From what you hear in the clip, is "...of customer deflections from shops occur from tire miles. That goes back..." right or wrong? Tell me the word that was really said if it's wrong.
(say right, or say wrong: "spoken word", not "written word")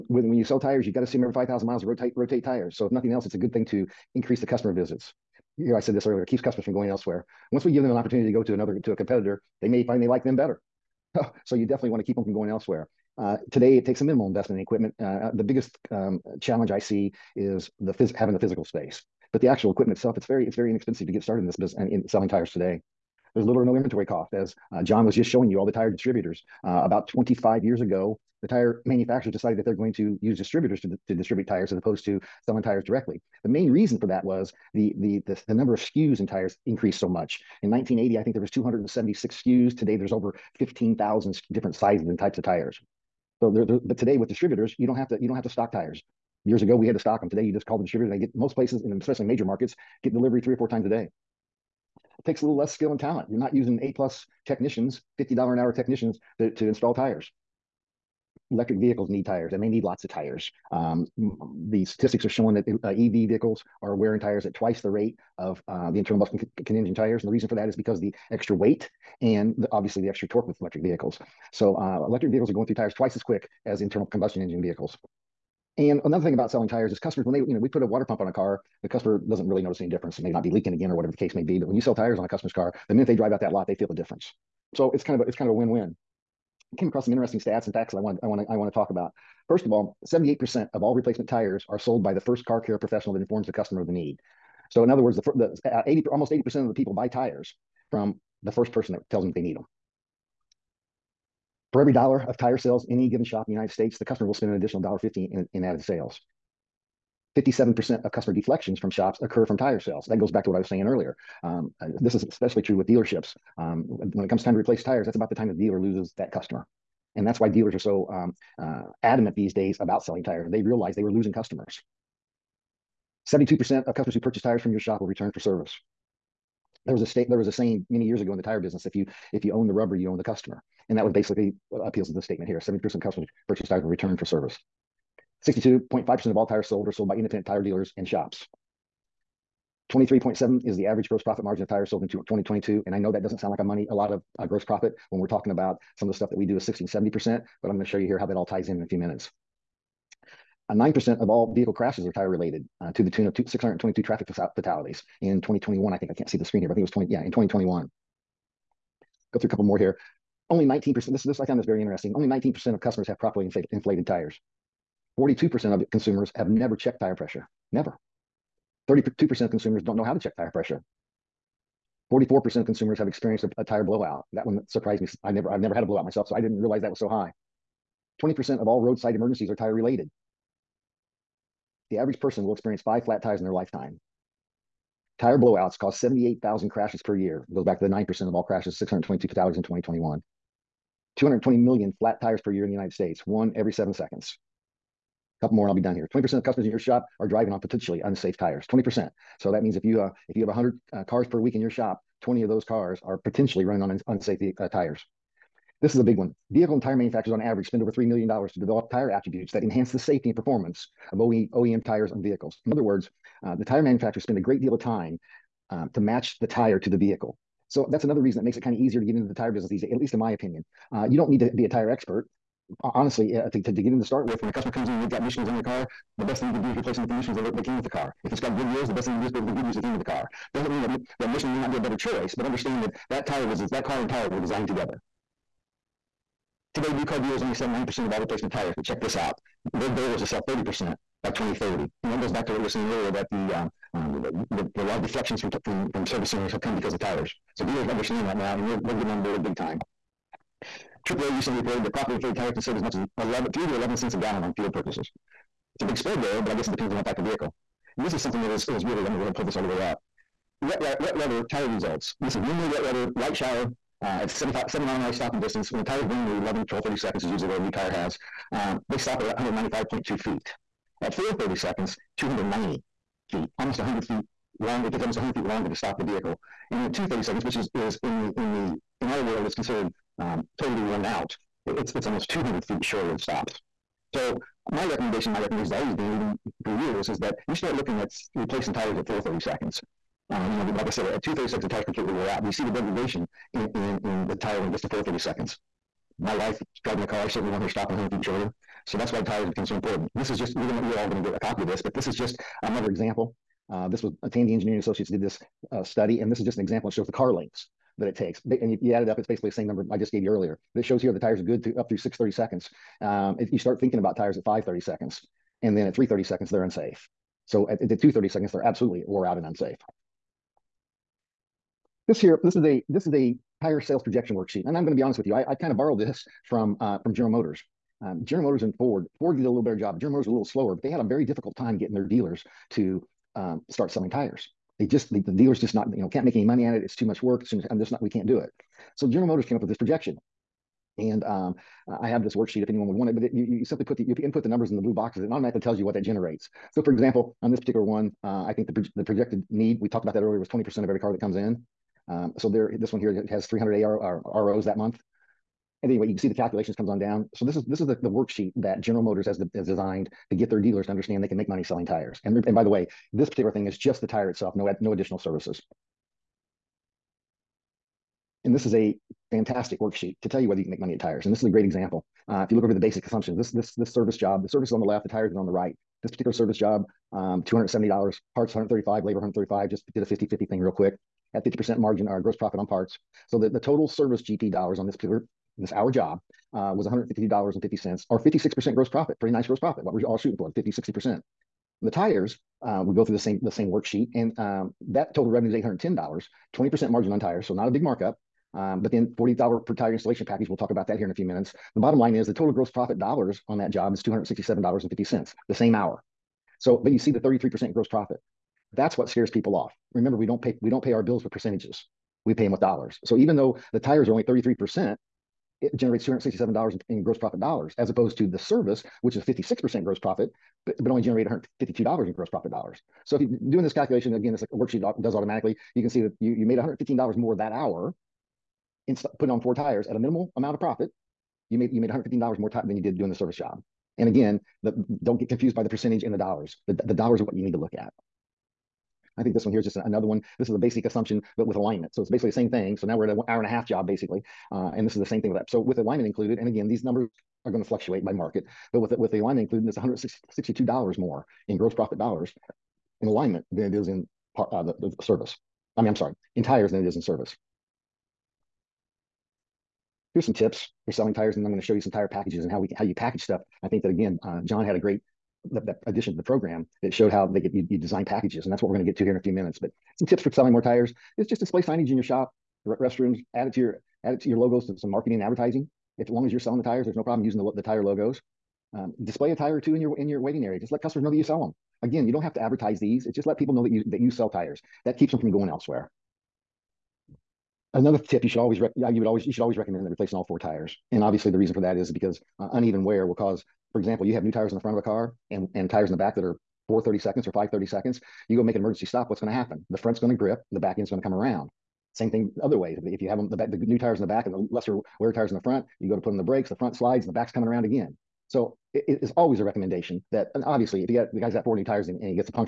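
wrong: "sales", not "miles".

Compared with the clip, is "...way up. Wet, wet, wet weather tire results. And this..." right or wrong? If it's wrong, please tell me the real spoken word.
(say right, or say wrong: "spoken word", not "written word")
right.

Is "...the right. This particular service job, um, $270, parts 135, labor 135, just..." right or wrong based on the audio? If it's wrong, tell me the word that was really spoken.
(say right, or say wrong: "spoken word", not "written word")
right.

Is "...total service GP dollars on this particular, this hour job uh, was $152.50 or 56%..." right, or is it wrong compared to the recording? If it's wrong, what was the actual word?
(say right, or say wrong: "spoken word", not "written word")
right.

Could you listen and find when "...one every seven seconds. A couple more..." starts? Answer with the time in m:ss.
3:13.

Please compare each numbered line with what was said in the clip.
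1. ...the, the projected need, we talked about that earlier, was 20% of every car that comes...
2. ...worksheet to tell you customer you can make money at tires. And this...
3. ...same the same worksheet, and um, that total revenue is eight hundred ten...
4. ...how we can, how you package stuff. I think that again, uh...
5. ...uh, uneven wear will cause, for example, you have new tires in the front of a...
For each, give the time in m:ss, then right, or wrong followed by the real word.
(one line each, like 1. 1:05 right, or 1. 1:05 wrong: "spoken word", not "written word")
1. 5:48 right
2. 6:09 wrong: "whether", not "customer"
3. 6:33 right
4. 7:42 right
5. 8:12 right.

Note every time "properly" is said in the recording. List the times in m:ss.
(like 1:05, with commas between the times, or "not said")
2:43, 4:11.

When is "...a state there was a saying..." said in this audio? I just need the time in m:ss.
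2:07.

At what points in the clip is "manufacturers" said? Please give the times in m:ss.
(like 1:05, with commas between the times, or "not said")
0:28, 3:26, 3:33.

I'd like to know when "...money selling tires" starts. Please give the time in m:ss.
6:01.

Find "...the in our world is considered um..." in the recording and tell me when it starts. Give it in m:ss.
4:38.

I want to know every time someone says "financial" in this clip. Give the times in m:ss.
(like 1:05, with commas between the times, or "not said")
not said.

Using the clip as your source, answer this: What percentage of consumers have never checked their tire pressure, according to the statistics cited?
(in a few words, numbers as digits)
42%.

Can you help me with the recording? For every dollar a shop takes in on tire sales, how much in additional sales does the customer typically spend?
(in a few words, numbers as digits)
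$1.50.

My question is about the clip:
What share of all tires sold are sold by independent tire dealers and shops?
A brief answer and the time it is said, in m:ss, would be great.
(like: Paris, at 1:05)
62.5%, at 2:15.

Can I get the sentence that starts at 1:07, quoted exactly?
And the reason for that is because the extra weight and the, obviously the extra torque with electric vehicles.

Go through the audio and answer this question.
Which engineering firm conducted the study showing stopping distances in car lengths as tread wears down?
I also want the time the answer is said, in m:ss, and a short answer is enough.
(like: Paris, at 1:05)
Tandy Engineering Associates, at 5:04.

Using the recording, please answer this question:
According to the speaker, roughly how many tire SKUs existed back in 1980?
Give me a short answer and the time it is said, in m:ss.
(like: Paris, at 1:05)
276, at 0:38.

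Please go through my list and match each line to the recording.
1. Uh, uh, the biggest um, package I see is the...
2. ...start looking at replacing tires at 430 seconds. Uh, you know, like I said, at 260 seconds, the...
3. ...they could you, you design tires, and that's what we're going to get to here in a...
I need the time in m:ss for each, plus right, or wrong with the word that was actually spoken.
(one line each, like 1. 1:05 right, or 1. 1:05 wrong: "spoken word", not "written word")
1. 0:15 wrong: "challenge", not "package"
2. 4:47 wrong: "230", not "260"
3. 7:47 wrong: "packages", not "tires".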